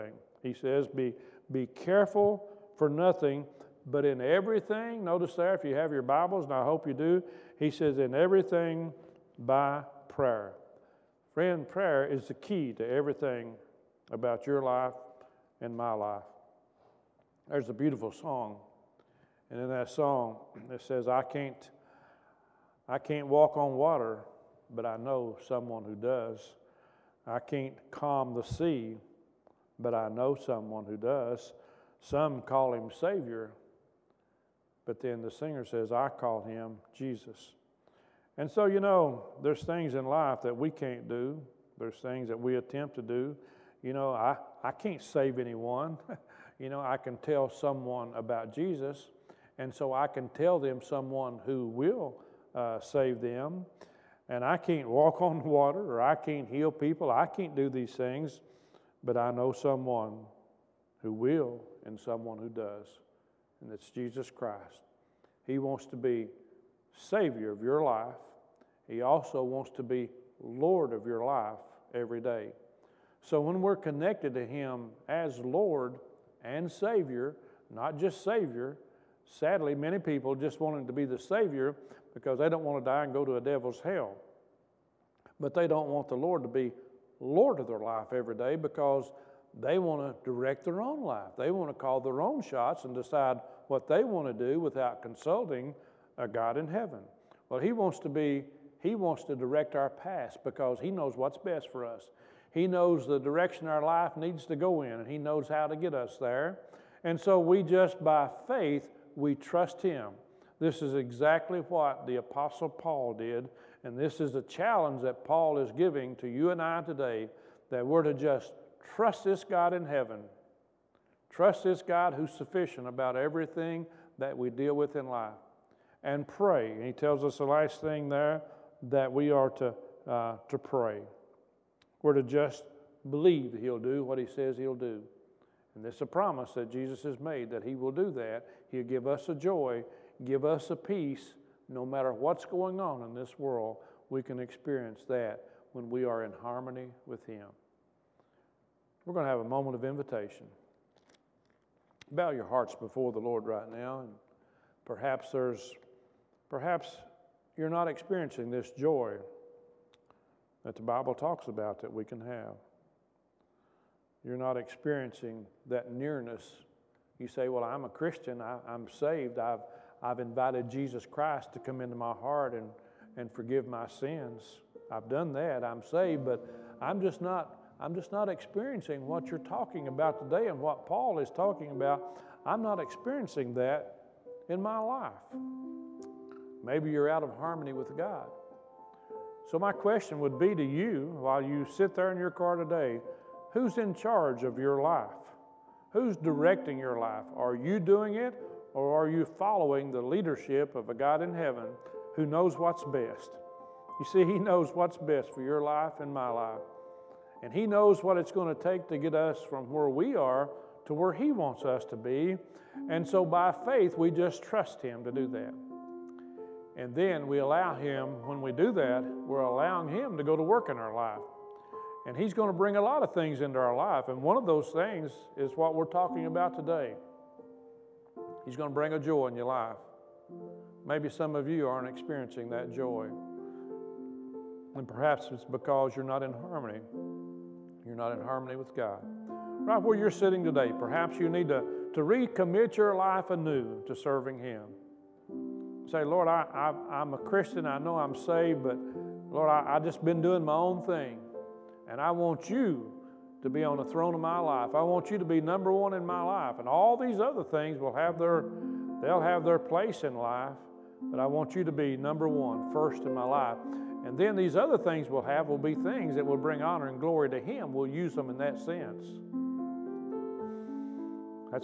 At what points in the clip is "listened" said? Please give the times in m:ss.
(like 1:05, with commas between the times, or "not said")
not said.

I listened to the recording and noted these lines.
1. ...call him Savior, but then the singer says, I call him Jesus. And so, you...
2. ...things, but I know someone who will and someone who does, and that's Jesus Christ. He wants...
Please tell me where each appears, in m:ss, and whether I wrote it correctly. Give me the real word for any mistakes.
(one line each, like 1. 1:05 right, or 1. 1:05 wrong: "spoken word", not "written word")
1. 0:32 right
2. 0:57 right.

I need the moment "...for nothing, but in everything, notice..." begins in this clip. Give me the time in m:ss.
0:02.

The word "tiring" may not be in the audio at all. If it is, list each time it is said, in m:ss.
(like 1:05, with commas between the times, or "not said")
not said.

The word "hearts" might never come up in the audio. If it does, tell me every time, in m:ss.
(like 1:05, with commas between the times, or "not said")
2:32, 2:52.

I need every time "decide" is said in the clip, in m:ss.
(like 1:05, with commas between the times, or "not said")
1:32.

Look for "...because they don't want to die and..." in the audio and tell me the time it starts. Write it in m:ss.
1:22.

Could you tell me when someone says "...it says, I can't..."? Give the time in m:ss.
0:20.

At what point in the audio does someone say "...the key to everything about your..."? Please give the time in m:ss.
0:12.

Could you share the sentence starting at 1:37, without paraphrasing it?
Well, He wants to be, He wants to direct our path because He knows what's best for us.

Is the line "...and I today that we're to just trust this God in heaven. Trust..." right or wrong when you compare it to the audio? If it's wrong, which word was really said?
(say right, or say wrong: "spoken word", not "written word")
right.